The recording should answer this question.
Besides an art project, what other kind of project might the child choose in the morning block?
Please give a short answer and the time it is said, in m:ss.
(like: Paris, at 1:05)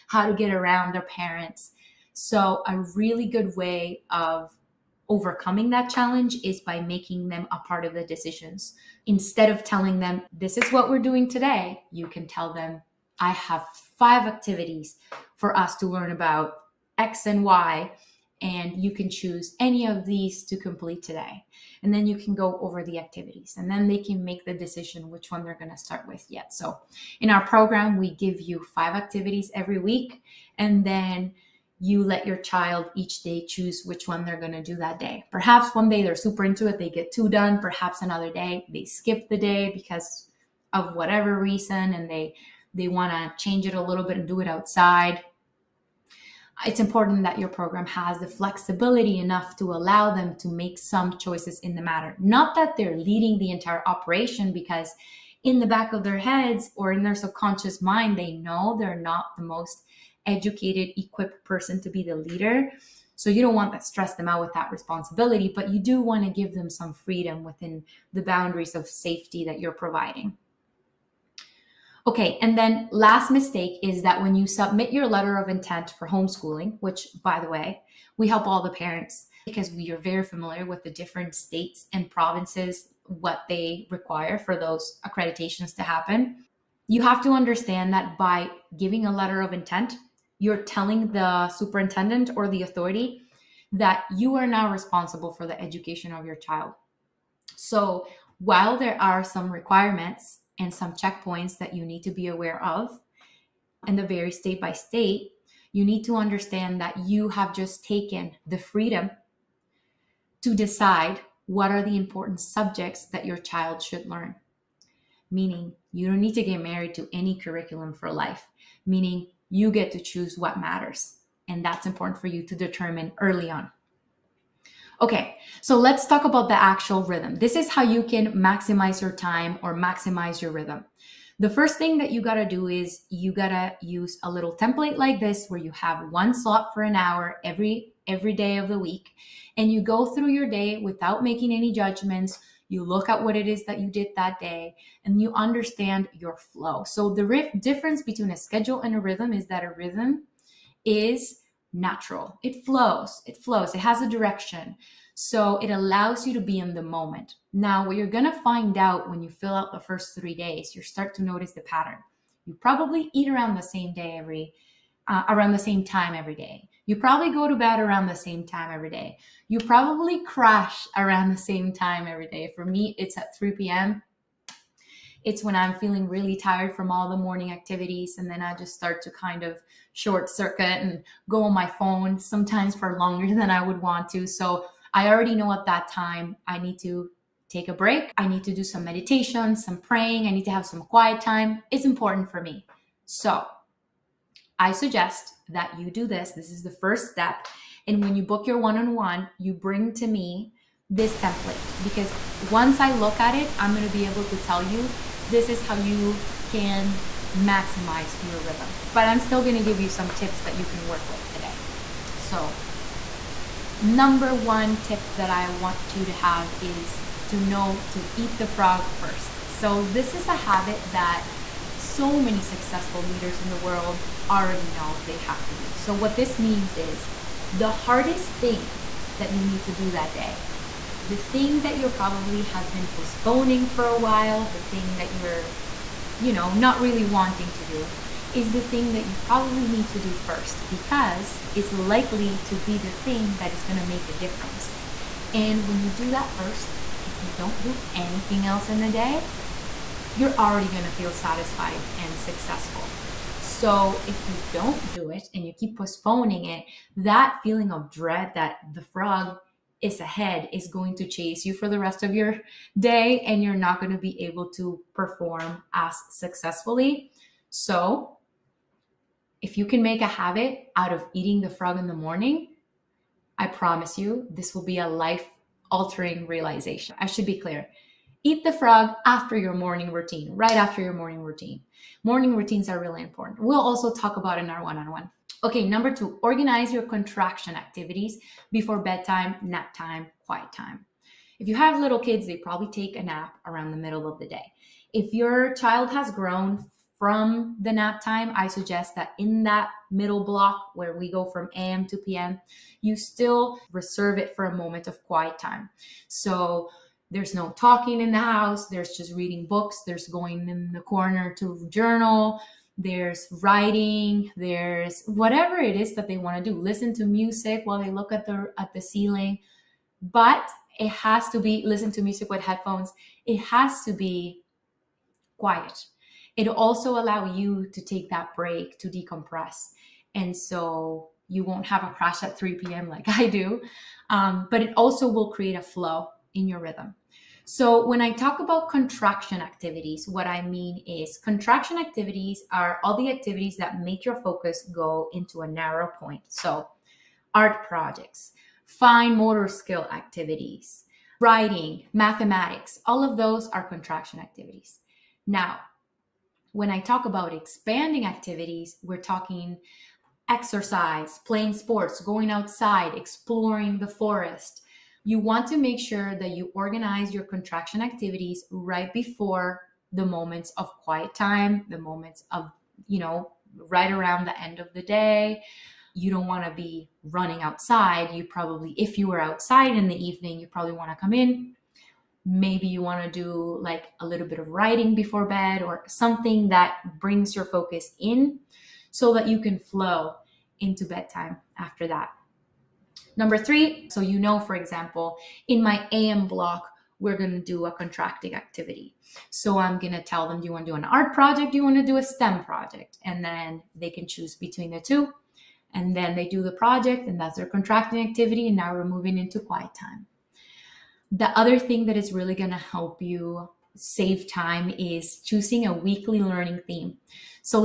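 STEM project, at 6:42.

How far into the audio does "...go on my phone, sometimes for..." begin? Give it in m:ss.
3:01.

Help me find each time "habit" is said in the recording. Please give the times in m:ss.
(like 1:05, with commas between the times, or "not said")
3:40, 4:30.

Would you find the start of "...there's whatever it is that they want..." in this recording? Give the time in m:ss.
5:14.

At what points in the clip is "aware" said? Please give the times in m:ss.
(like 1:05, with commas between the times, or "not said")
1:42.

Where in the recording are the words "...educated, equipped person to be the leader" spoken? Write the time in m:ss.
1:00.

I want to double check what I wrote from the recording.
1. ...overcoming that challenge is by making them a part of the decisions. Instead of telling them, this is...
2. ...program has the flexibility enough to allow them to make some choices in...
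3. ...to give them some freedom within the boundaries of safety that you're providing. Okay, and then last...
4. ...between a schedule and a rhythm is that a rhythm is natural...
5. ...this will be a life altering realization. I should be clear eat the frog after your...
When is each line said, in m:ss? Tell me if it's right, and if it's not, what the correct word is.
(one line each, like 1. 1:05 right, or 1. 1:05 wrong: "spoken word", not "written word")
1. 0:05 right
2. 0:47 right
3. 1:06 right
4. 2:28 right
5. 4:34 right.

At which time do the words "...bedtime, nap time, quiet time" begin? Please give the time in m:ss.
4:48.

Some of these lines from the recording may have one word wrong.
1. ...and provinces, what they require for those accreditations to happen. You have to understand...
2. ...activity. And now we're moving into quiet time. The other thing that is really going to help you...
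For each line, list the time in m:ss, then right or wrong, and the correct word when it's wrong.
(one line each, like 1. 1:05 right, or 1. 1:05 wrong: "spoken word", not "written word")
1. 1:21 right
2. 6:48 right.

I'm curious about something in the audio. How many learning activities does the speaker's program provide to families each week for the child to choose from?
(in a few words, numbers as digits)
5.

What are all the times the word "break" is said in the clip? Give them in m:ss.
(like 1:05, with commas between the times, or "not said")
3:07, 5:28.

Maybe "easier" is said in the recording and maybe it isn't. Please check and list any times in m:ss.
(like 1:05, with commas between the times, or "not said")
not said.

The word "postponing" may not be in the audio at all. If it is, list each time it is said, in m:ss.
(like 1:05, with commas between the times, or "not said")
3:52, 4:15.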